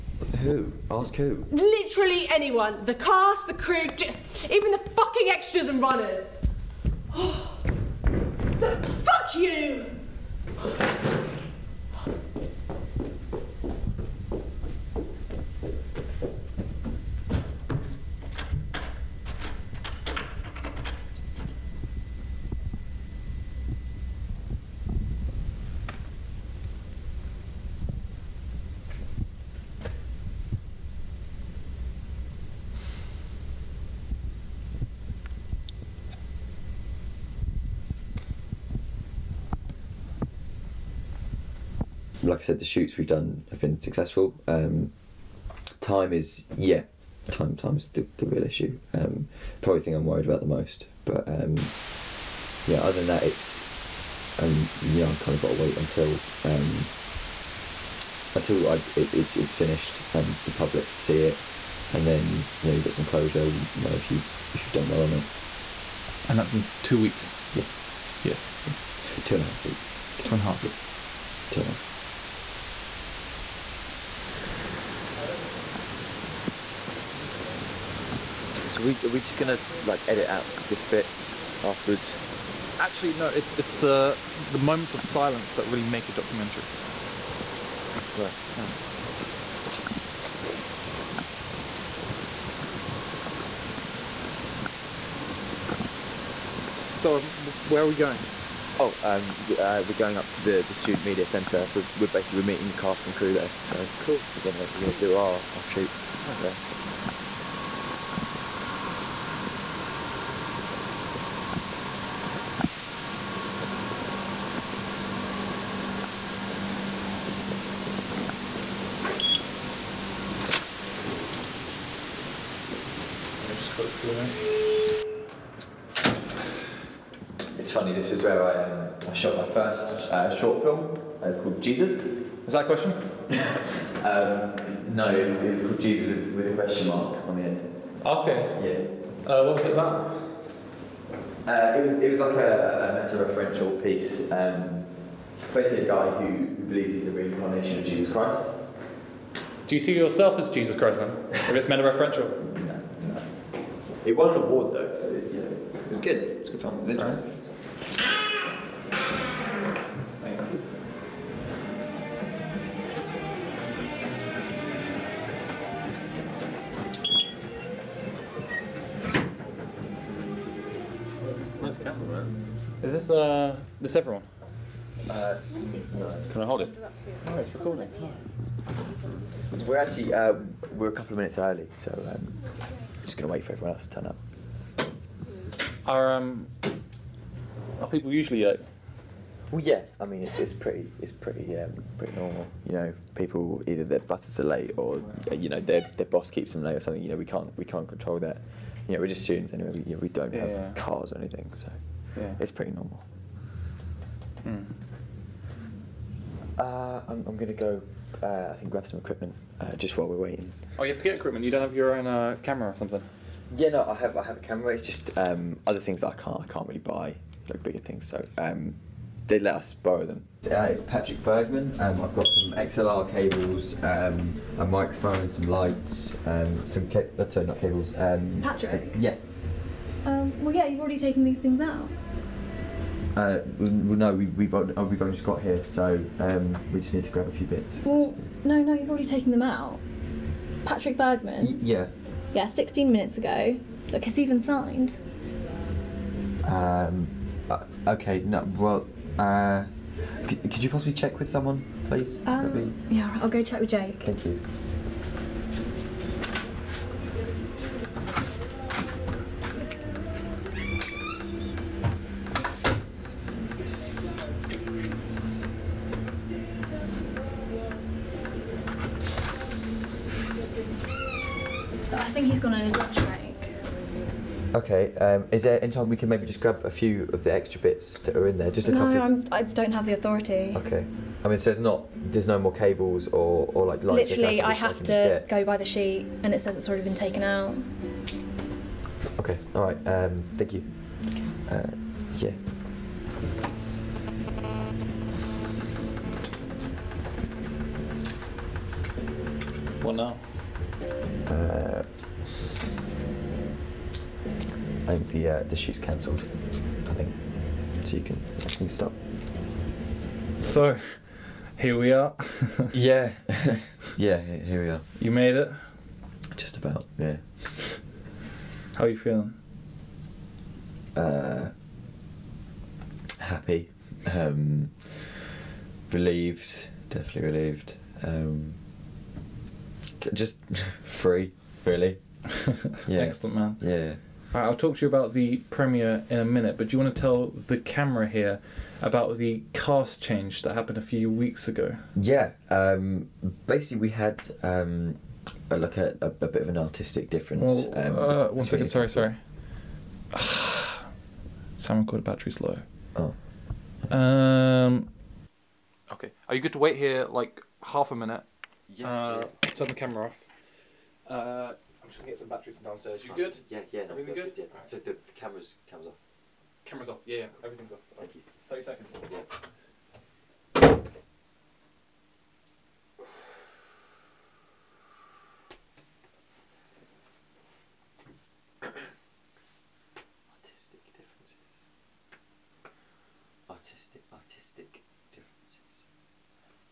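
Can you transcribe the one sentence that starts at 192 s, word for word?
You know, people either their butters are late or you know their, their boss keeps them late or something.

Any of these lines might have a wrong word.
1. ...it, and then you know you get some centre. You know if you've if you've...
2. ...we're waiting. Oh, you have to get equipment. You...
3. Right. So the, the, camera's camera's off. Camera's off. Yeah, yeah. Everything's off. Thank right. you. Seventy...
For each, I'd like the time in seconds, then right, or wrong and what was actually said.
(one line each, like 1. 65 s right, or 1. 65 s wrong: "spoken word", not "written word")
1. 61 s wrong: "closure", not "centre"
2. 210 s right
3. 364 s wrong: "Thirty", not "Seventy".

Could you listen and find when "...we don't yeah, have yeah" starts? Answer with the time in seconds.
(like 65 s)
199 s.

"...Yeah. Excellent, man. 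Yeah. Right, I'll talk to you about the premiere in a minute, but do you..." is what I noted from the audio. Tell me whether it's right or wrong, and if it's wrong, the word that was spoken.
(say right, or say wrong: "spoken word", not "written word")
right.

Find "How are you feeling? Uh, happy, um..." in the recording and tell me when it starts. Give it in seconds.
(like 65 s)
318 s.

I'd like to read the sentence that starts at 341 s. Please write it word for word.
Yeah, um, basically we had um, a look at a, a, bit of an artistic difference.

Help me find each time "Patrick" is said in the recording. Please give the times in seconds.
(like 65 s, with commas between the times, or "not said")
220 s, 228 s, 240 s.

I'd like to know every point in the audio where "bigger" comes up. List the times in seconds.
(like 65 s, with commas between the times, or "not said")
217 s.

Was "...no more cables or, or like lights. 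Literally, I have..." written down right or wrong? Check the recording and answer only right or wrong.
right.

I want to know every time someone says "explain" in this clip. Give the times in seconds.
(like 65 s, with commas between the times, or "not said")
not said.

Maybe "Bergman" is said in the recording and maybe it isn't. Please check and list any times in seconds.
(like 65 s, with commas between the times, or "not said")
221 s, 240 s.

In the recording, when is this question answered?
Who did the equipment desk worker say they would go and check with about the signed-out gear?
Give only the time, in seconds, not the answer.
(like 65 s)
253 s.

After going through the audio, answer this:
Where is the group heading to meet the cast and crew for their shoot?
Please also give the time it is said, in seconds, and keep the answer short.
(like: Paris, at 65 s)
Student media centre, at 100 s.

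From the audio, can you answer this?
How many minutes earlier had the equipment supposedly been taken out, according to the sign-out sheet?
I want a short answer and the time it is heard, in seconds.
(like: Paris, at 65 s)
16, at 242 s.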